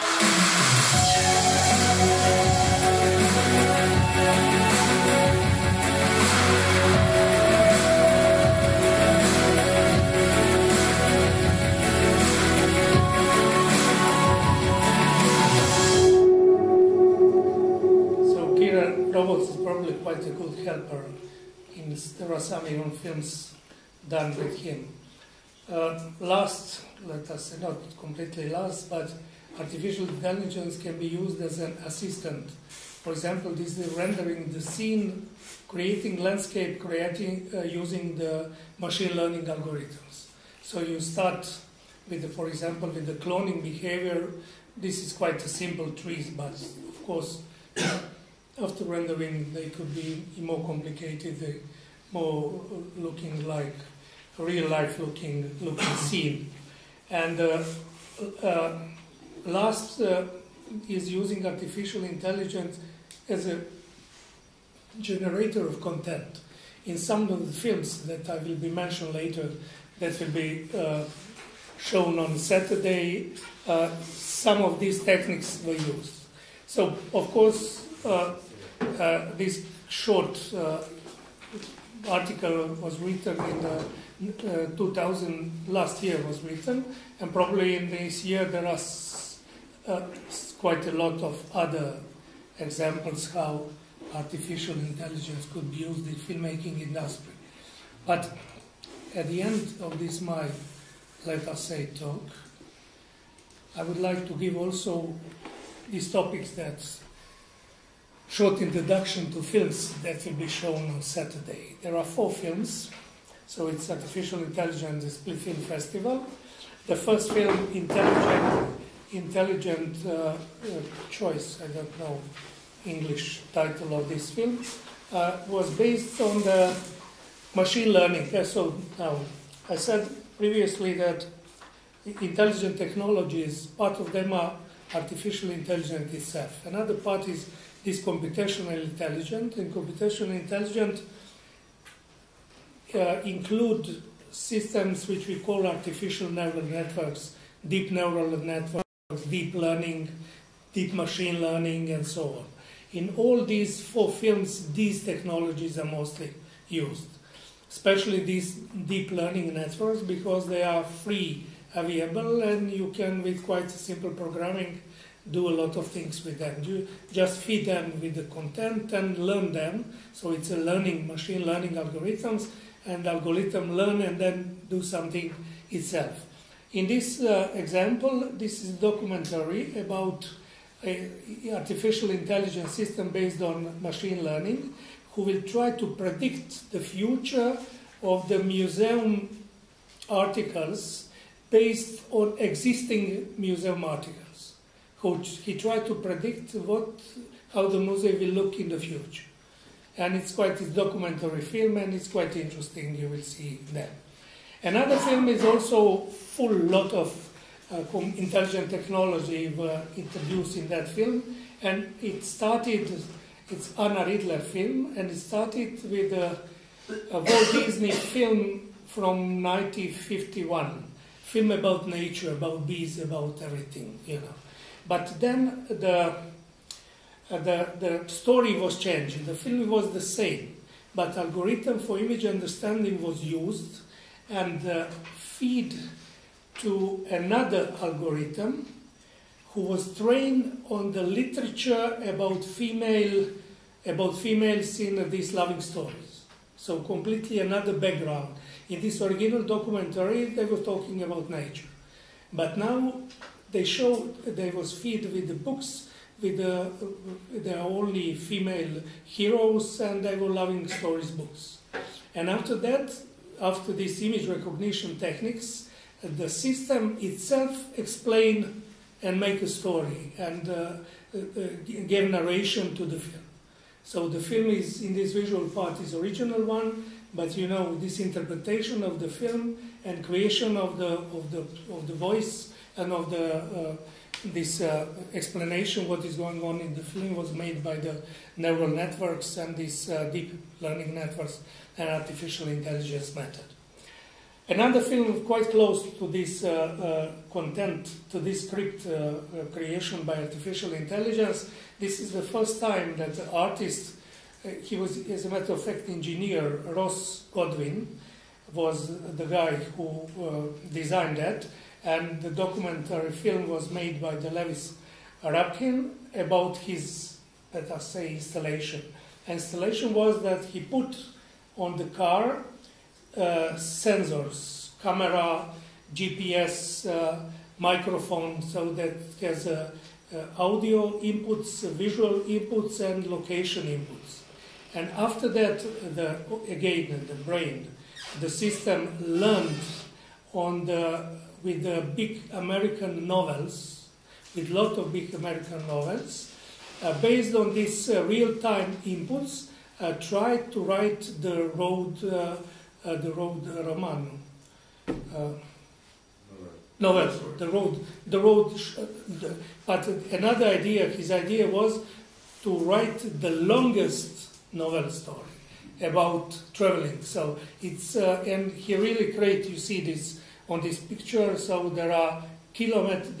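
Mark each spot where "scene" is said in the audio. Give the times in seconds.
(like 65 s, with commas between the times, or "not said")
34 s, 55 s.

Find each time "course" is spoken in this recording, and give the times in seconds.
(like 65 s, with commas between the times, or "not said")
47 s, 77 s.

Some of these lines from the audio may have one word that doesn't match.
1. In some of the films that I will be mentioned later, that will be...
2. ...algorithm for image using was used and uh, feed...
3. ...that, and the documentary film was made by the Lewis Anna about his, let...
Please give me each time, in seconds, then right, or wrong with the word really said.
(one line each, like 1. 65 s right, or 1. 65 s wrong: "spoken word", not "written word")
1. 66 s right
2. 231 s wrong: "understanding", not "using"
3. 311 s wrong: "Rapkin", not "Anna".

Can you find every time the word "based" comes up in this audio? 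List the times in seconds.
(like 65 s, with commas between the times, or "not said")
125 s, 183 s, 191 s, 346 s.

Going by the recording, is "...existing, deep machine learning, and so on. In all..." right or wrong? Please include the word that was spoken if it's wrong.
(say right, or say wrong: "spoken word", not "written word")
wrong: "learning", not "existing".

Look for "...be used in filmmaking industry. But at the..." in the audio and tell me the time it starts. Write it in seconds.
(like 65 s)
95 s.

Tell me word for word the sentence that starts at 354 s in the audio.
Uh, novel, the road, the road.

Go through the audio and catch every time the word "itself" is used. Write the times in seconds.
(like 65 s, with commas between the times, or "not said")
136 s, 175 s, 266 s.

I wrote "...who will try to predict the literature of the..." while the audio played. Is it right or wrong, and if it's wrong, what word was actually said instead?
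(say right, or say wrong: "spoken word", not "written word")
wrong: "future", not "literature".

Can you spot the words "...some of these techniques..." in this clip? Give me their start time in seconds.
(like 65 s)
74 s.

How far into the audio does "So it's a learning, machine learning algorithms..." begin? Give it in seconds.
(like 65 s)
170 s.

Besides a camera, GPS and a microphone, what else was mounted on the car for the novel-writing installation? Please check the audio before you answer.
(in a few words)
Sensors.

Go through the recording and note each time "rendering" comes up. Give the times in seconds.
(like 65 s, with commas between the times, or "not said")
33 s, 48 s.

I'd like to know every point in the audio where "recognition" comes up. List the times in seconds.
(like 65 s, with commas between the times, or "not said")
264 s.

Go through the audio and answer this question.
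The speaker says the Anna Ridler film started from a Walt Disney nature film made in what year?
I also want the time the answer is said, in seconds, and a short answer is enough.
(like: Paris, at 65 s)
1951, at 219 s.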